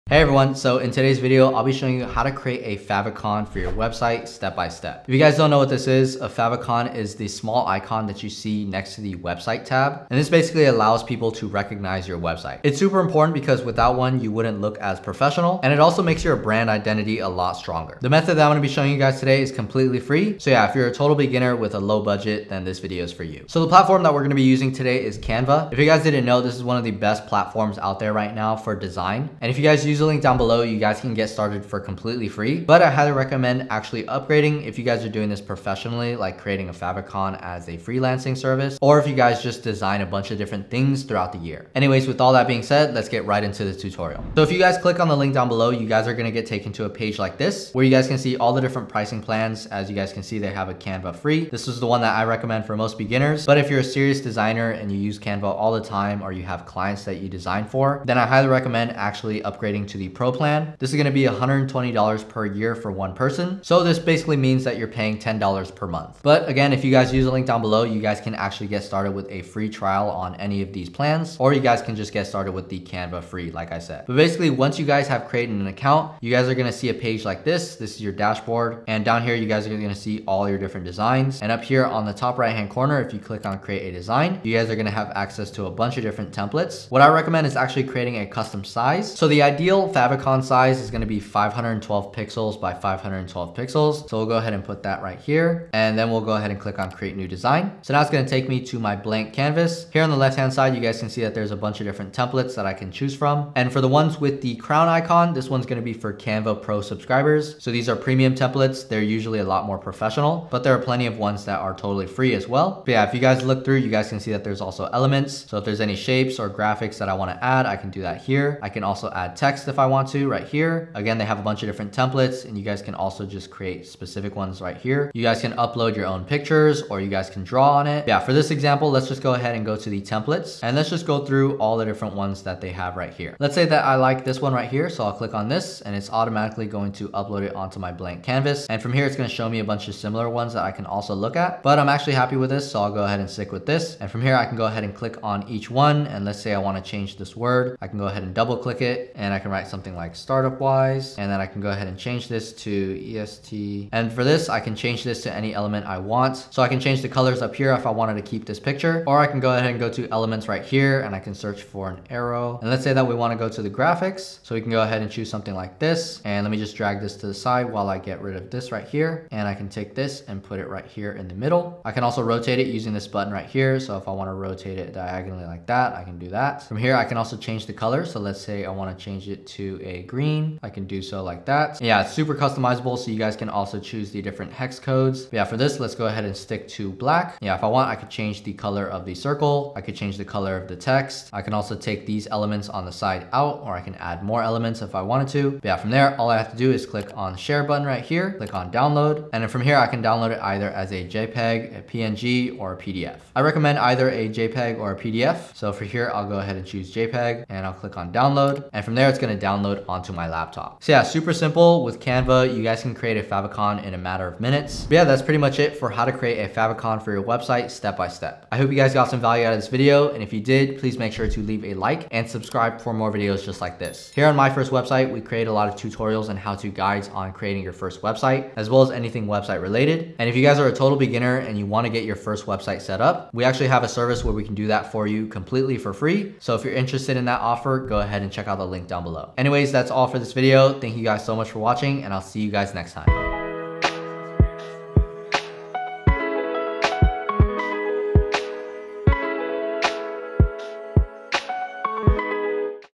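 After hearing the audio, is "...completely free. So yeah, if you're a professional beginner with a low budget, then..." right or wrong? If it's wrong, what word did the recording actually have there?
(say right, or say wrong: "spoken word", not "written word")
wrong: "total", not "professional".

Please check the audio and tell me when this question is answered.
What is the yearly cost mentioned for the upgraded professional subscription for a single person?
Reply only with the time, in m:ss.
1:01.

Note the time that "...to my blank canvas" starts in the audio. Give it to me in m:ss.
1:38.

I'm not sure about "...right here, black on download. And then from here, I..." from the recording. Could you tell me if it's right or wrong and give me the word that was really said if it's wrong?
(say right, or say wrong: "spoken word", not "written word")
wrong: "click", not "black".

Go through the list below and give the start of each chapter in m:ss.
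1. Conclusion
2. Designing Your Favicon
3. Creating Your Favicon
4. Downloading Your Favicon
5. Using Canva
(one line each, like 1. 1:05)
1. 3:35
2. 2:13
3. 1:14
4. 3:15
5. 0:23.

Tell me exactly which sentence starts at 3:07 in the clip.
Yeah, if I want, I could change the color of the circle.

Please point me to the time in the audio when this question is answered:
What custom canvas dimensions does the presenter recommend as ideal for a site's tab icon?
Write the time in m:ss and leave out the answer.
1:31.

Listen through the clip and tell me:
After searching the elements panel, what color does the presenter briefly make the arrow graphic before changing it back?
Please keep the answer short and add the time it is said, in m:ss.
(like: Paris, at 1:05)
Green, at 3:00.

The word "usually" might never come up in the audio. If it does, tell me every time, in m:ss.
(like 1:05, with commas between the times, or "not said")
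1:49.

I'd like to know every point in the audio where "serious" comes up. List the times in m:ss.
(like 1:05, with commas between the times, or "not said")
0:53.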